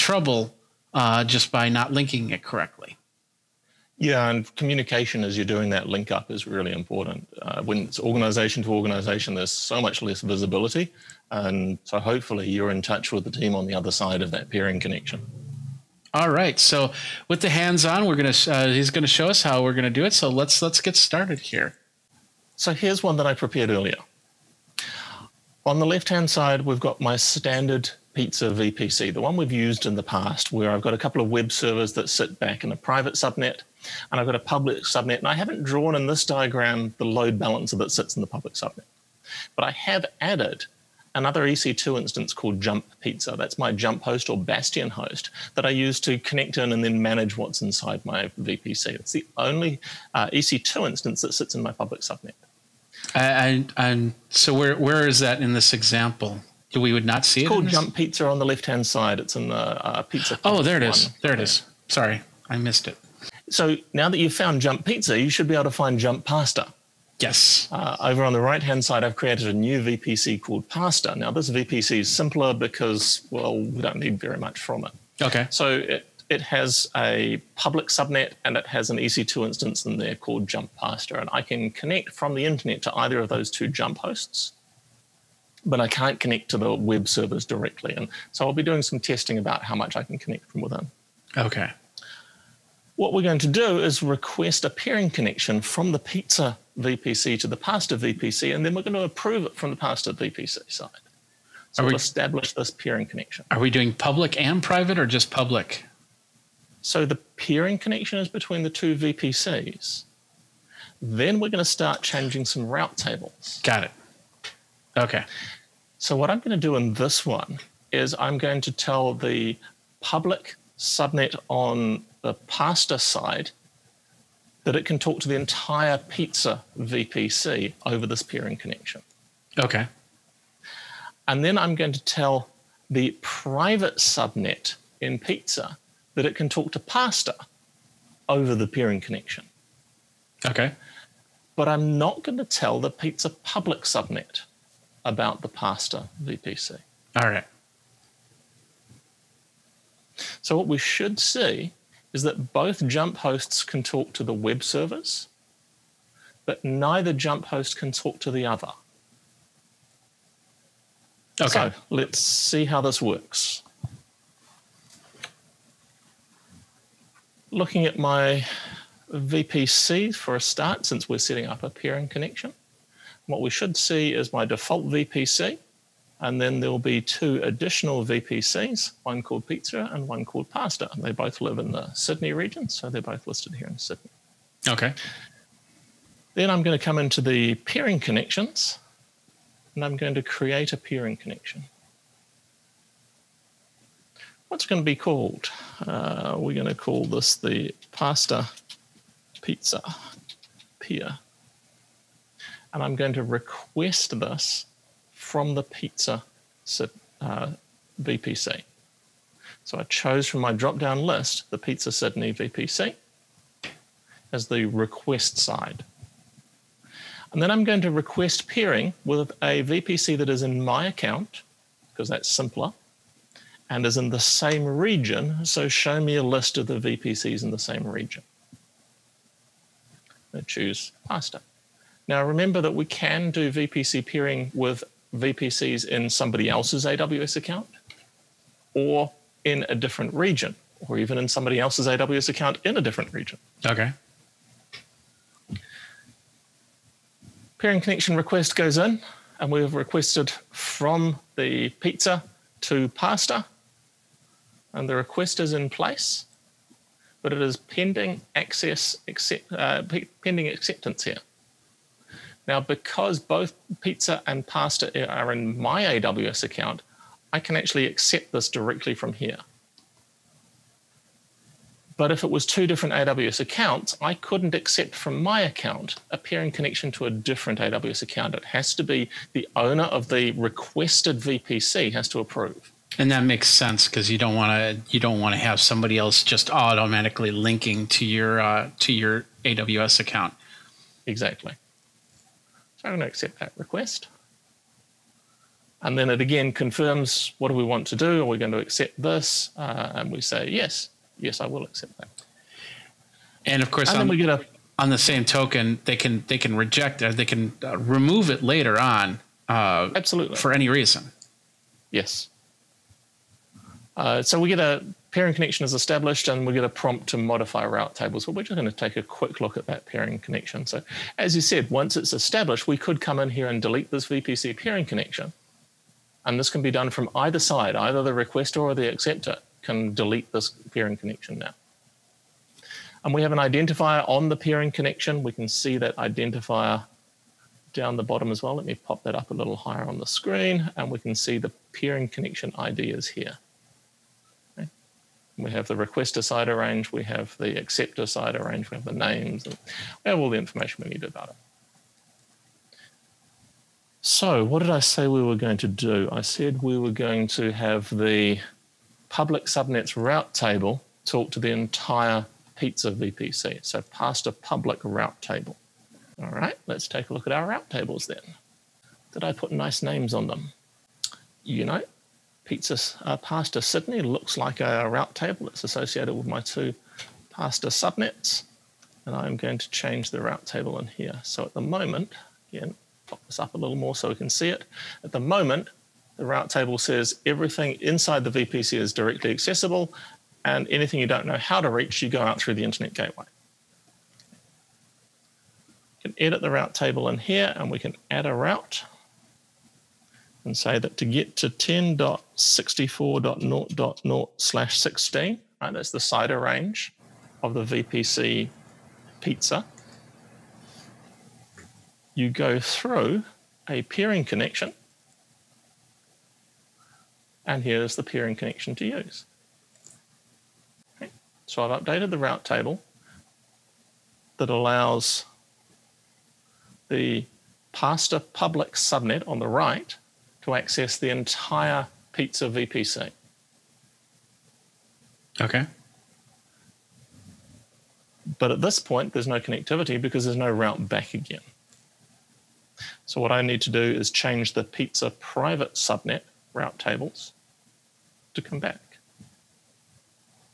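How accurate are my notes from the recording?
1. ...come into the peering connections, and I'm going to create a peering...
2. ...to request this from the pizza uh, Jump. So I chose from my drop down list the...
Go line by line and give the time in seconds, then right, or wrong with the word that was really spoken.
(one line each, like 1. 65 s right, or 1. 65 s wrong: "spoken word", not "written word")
1. 186 s right
2. 203 s wrong: "VPC", not "Jump".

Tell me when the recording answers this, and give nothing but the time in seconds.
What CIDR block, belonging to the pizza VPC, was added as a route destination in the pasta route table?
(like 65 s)
401 s.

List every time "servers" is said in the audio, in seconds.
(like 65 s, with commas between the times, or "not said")
31 s, 87 s, 154 s.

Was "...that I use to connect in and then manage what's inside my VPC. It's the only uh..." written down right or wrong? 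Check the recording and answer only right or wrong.
right.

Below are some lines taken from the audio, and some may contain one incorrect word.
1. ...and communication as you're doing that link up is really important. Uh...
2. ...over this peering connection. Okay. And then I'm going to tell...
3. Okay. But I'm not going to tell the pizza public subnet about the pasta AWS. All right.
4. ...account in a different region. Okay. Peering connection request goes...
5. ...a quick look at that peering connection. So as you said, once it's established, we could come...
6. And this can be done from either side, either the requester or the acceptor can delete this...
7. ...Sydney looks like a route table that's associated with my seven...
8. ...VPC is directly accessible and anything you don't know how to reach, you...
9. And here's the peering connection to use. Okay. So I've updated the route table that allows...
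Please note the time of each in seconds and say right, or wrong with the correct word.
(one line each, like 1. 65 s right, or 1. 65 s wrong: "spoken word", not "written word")
1. 4 s right
2. 127 s right
3. 140 s wrong: "VPC", not "AWS"
4. 242 s right
5. 318 s right
6. 326 s right
7. 373 s wrong: "two", not "seven"
8. 388 s right
9. 417 s right.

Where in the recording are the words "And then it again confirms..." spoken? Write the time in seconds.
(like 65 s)
295 s.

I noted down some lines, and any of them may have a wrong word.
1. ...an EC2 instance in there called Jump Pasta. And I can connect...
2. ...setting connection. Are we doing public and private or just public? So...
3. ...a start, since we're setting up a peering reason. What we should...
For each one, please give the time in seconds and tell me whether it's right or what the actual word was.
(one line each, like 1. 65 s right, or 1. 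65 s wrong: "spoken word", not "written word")
1. 78 s right
2. 102 s wrong: "peering", not "setting"
3. 170 s wrong: "connection", not "reason".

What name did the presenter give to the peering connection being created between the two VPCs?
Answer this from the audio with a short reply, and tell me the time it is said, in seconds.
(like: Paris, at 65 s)
pasta pizza peer, at 197 s.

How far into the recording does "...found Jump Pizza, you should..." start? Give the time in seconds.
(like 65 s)
64 s.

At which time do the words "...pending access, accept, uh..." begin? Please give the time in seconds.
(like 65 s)
257 s.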